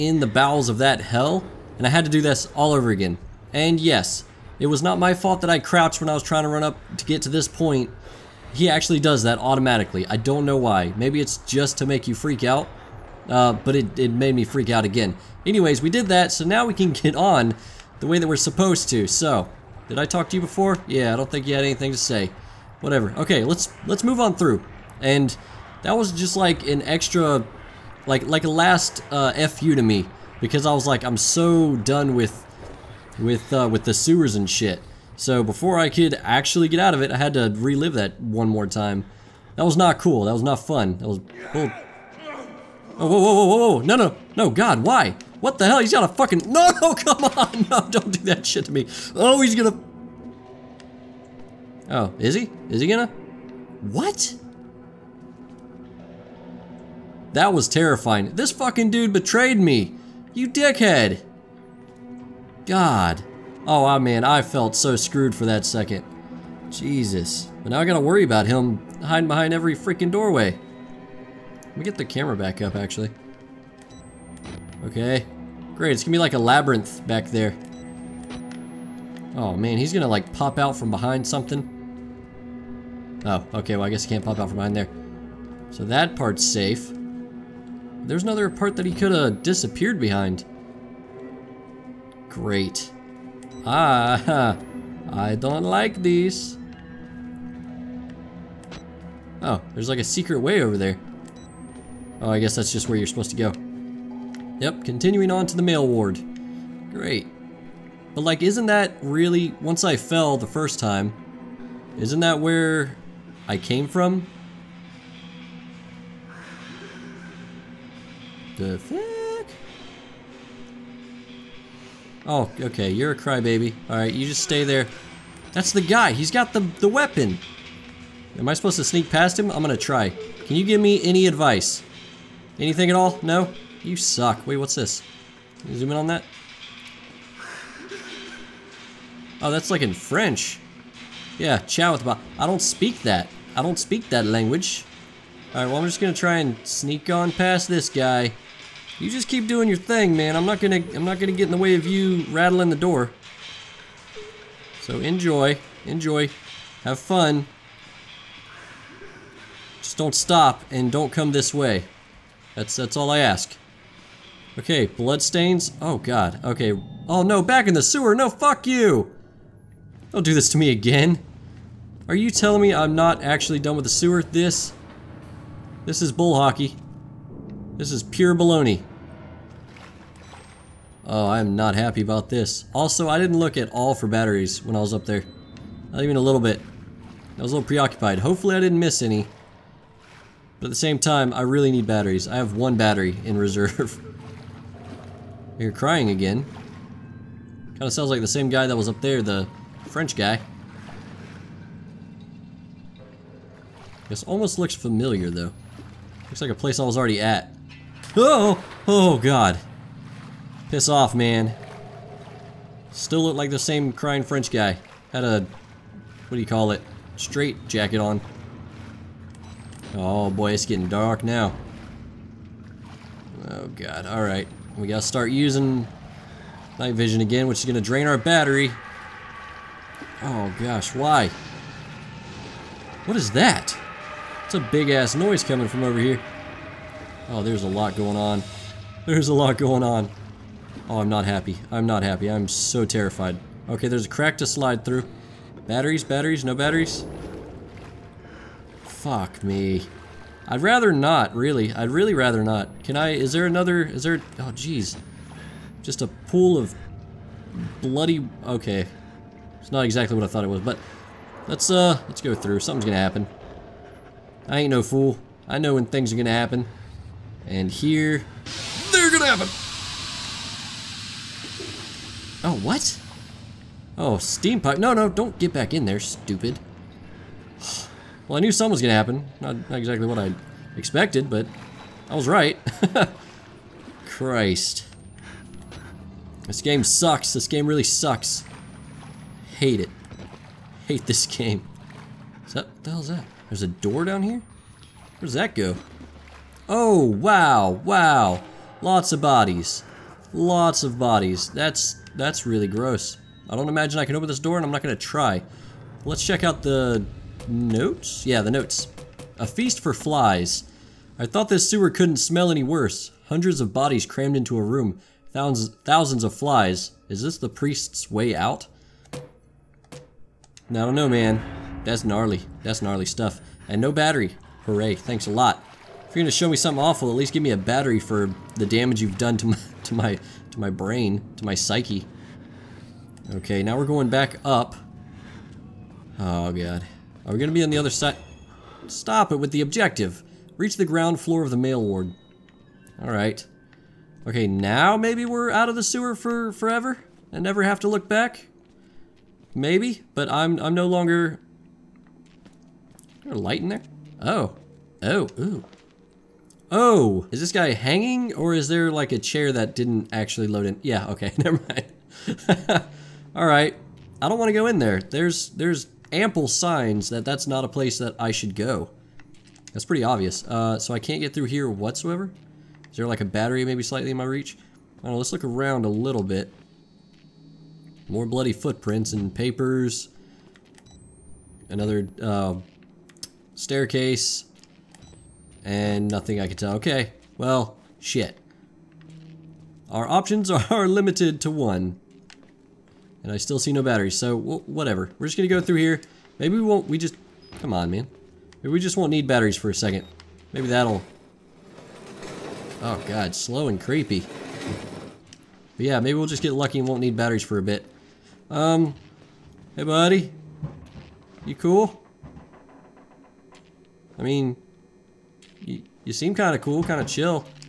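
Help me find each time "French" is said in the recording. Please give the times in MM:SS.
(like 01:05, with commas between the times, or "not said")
02:19, 03:19, 03:34.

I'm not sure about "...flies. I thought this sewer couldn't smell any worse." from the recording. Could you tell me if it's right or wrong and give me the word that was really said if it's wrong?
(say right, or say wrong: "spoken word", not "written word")
right.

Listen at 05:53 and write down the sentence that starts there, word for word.
Is there a light in there?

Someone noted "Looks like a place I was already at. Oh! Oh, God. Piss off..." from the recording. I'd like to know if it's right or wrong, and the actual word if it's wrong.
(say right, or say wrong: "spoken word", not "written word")
right.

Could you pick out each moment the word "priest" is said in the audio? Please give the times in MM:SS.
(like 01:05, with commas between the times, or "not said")
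05:17.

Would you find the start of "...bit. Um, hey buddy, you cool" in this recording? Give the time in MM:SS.
06:47.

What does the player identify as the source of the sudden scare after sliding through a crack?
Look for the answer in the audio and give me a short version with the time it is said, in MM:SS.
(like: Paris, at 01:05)
steam pipe, at 04:34.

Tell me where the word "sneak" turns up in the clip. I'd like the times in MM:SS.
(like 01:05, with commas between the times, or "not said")
02:08, 02:26.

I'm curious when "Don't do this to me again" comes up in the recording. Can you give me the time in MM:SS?
02:50.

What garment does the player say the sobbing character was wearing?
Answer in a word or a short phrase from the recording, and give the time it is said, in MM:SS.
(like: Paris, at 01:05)
straight jacket, at 03:37.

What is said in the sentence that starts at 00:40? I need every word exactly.
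That was bull Oh, whoa, whoa, whoa, whoa, no, no, no, God, why?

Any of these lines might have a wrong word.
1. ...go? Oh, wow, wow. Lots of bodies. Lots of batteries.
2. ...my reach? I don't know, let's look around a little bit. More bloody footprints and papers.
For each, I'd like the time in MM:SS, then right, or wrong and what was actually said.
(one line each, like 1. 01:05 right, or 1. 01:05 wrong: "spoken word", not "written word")
1. 04:55 wrong: "bodies", not "batteries"
2. 06:14 right.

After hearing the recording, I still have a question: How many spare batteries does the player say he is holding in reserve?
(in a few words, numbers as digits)
1.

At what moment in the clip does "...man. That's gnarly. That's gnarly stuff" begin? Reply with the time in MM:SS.
05:21.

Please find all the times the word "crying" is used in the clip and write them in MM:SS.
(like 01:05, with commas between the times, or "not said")
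03:15, 03:33.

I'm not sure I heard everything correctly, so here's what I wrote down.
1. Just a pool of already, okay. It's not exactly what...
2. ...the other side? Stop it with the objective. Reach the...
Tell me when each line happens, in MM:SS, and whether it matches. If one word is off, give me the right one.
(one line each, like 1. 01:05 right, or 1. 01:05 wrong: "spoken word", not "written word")
1. 04:15 wrong: "bloody", not "already"
2. 05:37 right.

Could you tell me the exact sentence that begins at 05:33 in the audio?
Okay, now we're going back up.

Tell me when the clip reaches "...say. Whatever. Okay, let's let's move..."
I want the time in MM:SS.
00:21.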